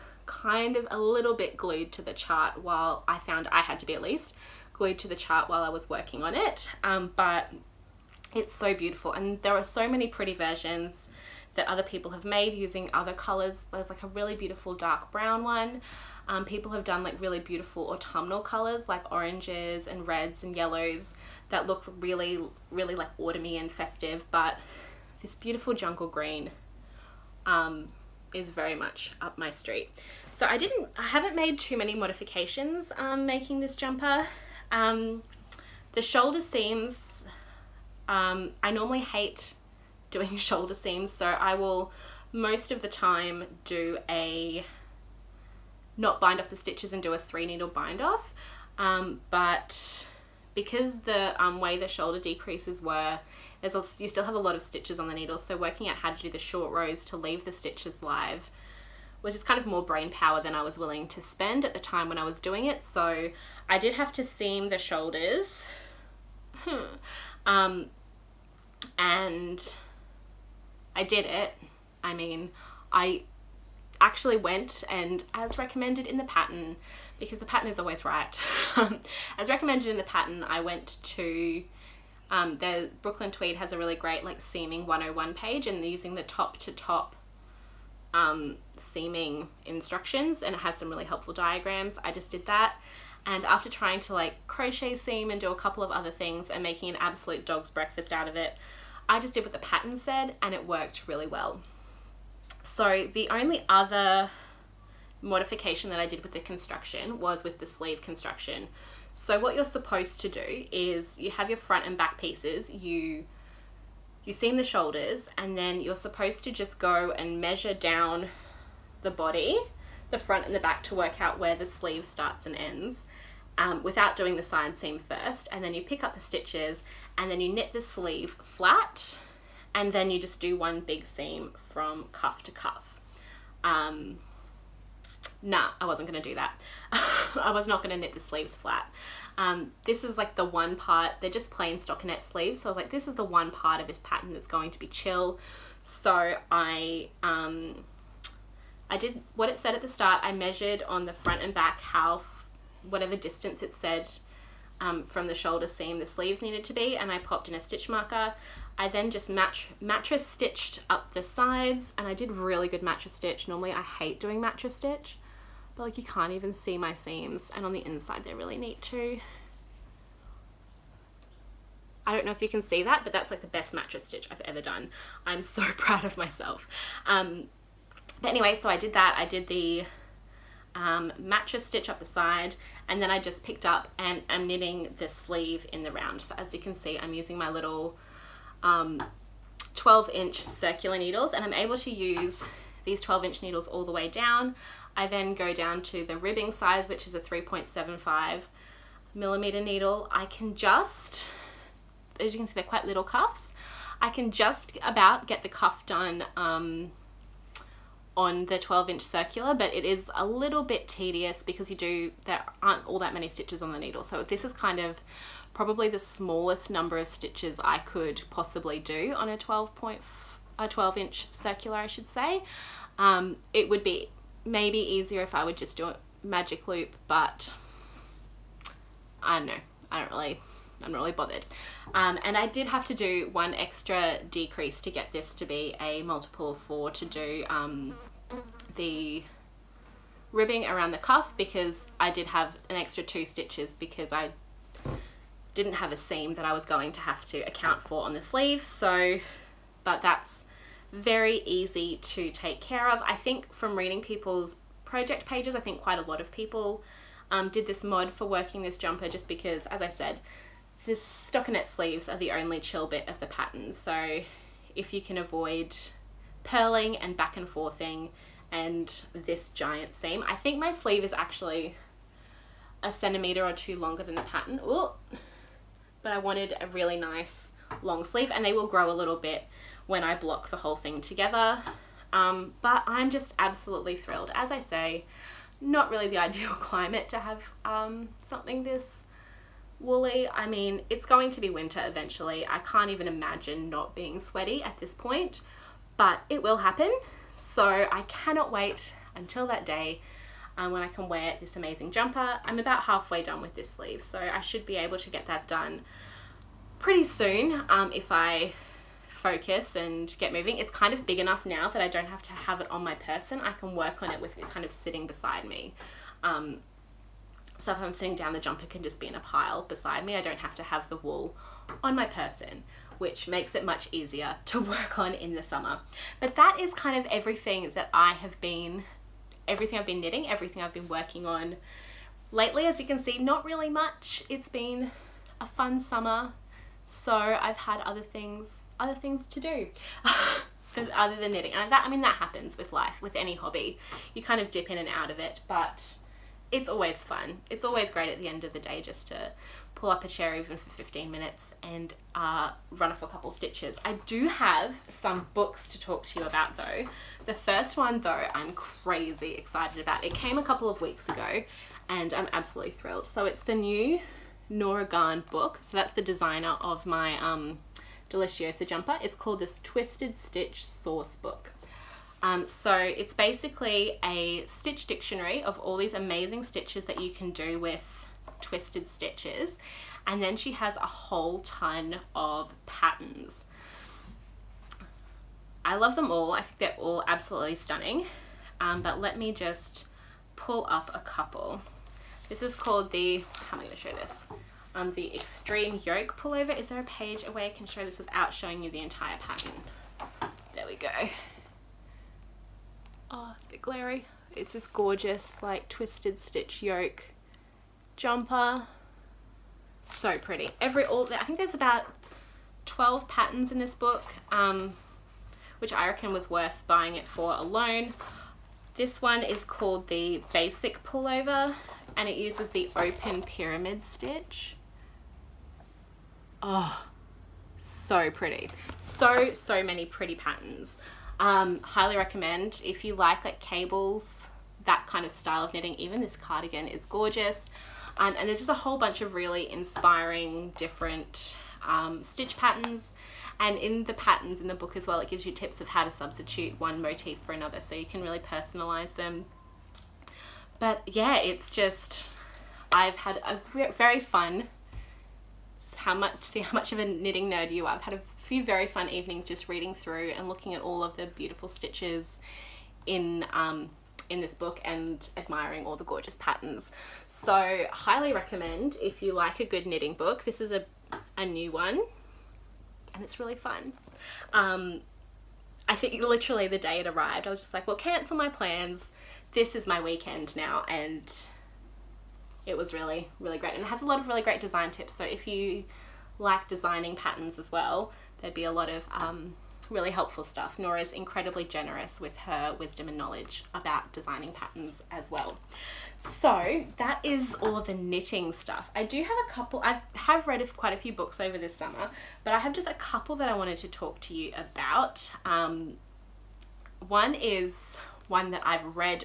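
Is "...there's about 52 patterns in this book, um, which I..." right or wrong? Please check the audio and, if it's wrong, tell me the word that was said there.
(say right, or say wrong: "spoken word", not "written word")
wrong: "12", not "52".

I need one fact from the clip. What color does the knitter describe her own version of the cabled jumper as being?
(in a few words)
jungle green.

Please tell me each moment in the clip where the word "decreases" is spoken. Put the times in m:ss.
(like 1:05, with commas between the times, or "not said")
0:52, 3:54.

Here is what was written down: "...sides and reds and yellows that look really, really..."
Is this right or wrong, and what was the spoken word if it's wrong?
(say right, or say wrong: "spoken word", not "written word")
wrong: "oranges", not "sides".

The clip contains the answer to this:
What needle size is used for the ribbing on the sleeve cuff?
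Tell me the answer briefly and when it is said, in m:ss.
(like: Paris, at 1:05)
3.75 millimeter, at 3:17.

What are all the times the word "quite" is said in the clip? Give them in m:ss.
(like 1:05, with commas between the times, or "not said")
3:22, 4:15, 8:20.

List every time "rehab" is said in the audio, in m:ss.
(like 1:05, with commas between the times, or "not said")
not said.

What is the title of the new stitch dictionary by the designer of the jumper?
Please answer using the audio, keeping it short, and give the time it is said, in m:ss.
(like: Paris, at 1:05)
Twisted Stitch Source Book, at 6:09.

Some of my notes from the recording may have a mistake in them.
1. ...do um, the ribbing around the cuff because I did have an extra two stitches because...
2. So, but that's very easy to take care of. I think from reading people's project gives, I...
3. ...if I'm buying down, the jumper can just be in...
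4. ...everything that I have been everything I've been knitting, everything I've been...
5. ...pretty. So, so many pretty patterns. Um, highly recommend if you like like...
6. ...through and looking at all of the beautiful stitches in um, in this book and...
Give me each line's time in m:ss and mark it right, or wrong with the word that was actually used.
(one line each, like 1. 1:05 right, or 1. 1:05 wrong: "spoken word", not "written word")
1. 3:57 right
2. 4:08 wrong: "pages", not "gives"
3. 5:17 wrong: "sitting", not "buying"
4. 5:27 right
5. 7:08 right
6. 7:39 right.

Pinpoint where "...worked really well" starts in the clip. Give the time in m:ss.
1:40.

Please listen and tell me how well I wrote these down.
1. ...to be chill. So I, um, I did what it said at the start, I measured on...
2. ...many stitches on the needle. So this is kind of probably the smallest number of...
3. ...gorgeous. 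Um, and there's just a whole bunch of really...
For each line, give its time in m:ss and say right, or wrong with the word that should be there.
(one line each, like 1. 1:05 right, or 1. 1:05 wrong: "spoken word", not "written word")
1. 2:24 right
2. 3:33 right
3. 7:16 right.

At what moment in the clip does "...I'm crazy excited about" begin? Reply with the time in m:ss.
5:58.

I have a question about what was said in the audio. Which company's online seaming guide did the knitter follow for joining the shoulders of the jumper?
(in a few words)
Brooklyn Tweed.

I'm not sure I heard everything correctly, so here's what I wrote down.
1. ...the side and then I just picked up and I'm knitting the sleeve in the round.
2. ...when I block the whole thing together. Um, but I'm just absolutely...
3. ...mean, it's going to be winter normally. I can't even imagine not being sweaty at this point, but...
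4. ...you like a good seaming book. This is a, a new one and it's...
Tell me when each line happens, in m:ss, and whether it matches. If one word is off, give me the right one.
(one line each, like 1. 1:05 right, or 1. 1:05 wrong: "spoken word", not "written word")
1. 3:01 right
2. 4:39 right
3. 4:50 wrong: "eventually", not "normally"
4. 7:49 wrong: "knitting", not "seaming".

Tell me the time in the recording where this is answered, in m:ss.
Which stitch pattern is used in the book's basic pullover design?
7:02.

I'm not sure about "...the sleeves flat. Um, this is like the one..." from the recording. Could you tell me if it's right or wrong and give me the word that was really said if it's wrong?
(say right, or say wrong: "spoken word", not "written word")
right.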